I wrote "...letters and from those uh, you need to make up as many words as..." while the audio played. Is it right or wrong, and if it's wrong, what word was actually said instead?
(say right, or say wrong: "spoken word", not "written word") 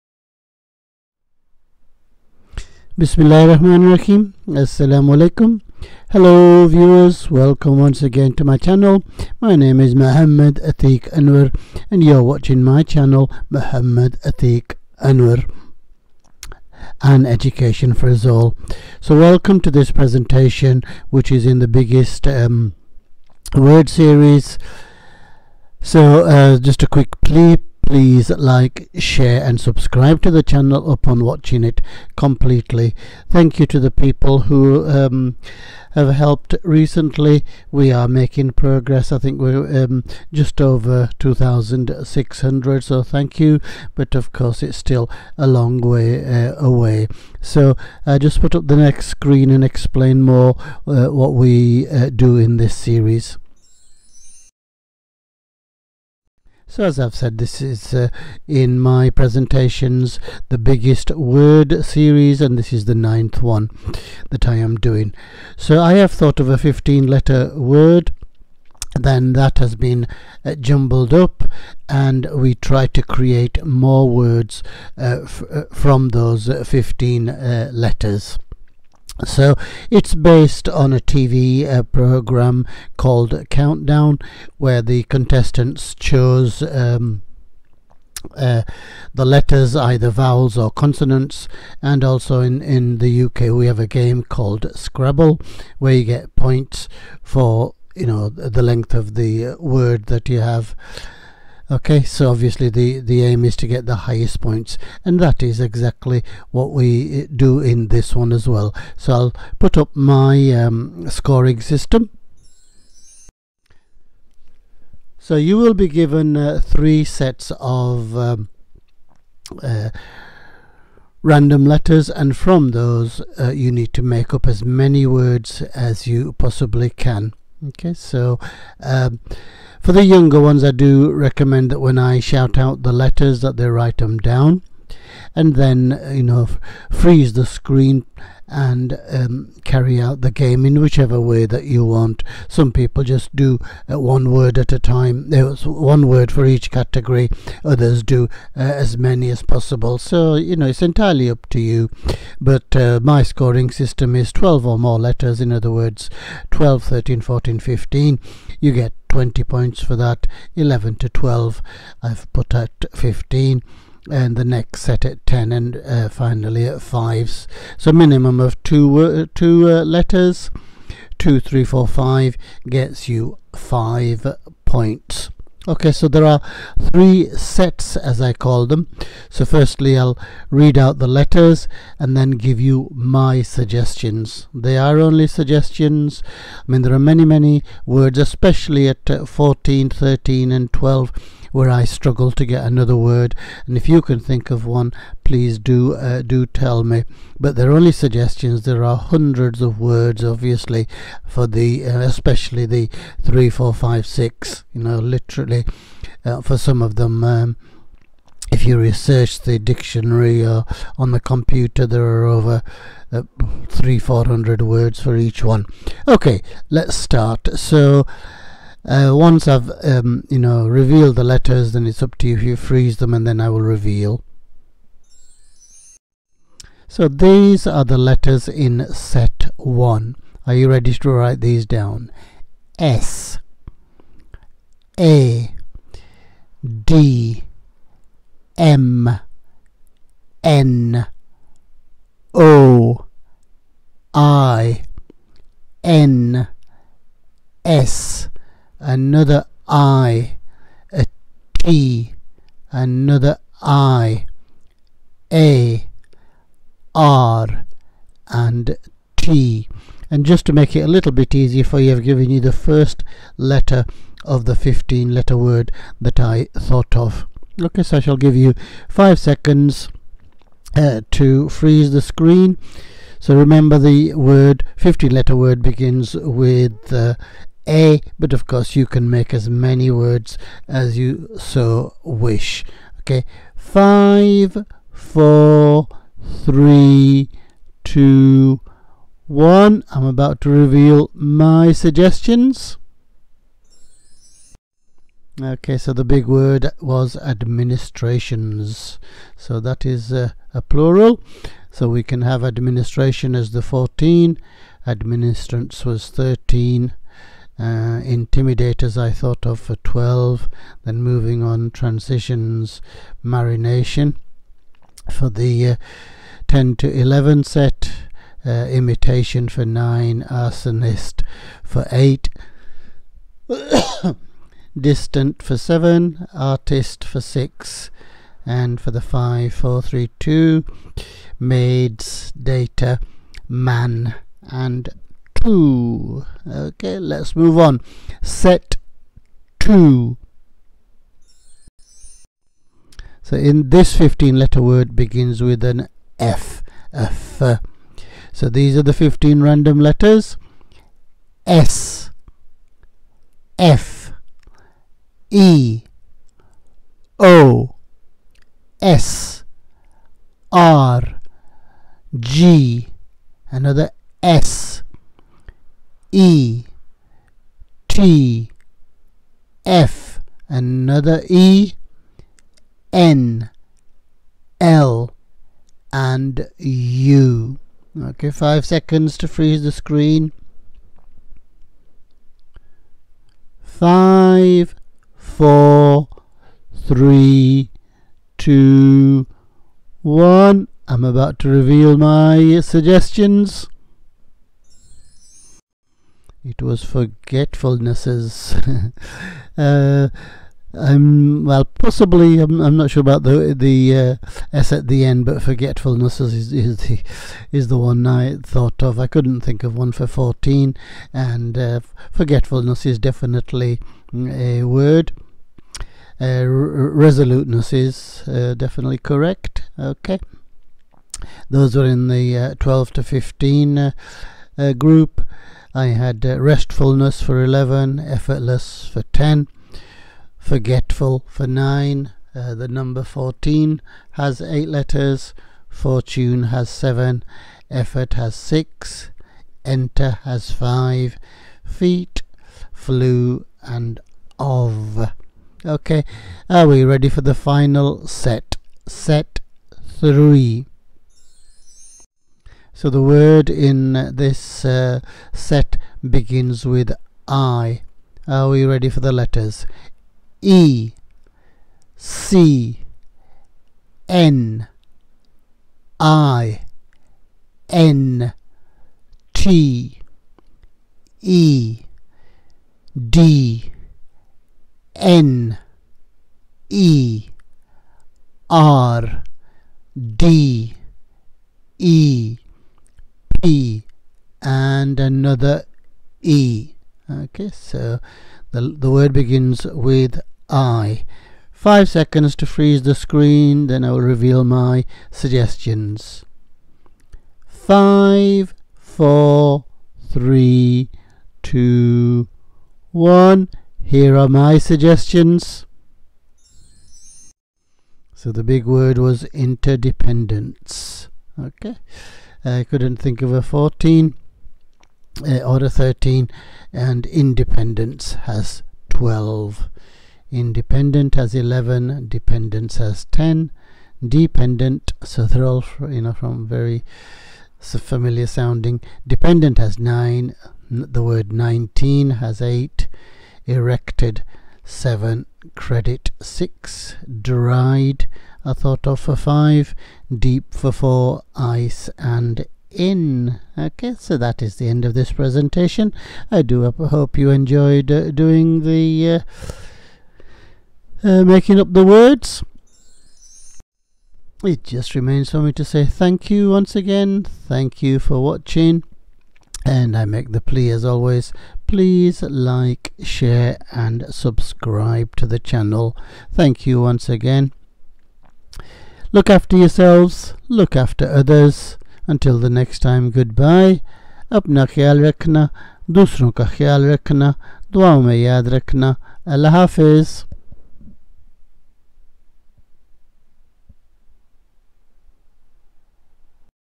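right.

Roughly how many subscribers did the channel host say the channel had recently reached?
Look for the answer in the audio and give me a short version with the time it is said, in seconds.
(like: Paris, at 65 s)
2600, at 40 s.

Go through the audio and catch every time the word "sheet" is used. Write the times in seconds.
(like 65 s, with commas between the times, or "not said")
not said.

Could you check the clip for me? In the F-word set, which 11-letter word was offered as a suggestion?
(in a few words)
restfulness.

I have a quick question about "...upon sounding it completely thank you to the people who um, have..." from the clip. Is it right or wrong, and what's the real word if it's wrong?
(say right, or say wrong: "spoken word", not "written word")
wrong: "watching", not "sounding".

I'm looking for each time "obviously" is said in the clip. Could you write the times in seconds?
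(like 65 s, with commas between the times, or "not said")
102 s, 200 s.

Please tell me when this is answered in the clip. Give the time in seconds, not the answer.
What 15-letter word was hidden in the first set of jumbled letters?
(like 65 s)
297 s.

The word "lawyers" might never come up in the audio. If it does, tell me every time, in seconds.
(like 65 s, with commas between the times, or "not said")
not said.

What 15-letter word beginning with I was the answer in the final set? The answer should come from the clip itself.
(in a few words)
interdependence.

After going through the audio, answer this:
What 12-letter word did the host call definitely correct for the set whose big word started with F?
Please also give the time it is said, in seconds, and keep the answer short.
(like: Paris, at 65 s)
resoluteness, at 416 s.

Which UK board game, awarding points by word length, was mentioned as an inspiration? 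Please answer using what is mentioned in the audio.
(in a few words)
Scrabble.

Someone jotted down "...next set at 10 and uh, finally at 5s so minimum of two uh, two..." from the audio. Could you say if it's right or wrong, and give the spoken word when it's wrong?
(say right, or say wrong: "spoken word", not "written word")
right.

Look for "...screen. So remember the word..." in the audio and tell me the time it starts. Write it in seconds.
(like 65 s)
272 s.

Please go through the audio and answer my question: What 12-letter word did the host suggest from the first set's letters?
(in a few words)
intimidators.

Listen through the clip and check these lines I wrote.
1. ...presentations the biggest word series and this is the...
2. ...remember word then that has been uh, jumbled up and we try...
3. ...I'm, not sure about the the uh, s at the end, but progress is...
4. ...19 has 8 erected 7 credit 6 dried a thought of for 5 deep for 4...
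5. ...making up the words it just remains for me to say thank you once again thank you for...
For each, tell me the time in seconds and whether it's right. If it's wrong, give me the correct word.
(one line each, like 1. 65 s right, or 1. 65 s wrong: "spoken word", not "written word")
1. 59 s right
2. 67 s wrong: "letter", not "remember"
3. 402 s wrong: "forgetfulness", not "progress"
4. 531 s right
5. 551 s right.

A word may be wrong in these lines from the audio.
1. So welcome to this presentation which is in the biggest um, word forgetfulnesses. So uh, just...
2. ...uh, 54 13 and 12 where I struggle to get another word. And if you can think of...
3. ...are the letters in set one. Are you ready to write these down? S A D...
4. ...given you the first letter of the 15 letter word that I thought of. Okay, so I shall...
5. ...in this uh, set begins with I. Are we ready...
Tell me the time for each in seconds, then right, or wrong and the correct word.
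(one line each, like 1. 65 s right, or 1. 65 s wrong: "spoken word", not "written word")
1. 18 s wrong: "series", not "forgetfulnesses"
2. 189 s wrong: "14", not "54"
3. 227 s right
4. 262 s right
5. 453 s right.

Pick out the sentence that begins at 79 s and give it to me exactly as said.
So it's based on a TV uh, program called Countdown, where the contestants chose.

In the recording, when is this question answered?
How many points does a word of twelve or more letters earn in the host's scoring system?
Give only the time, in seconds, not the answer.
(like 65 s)
159 s.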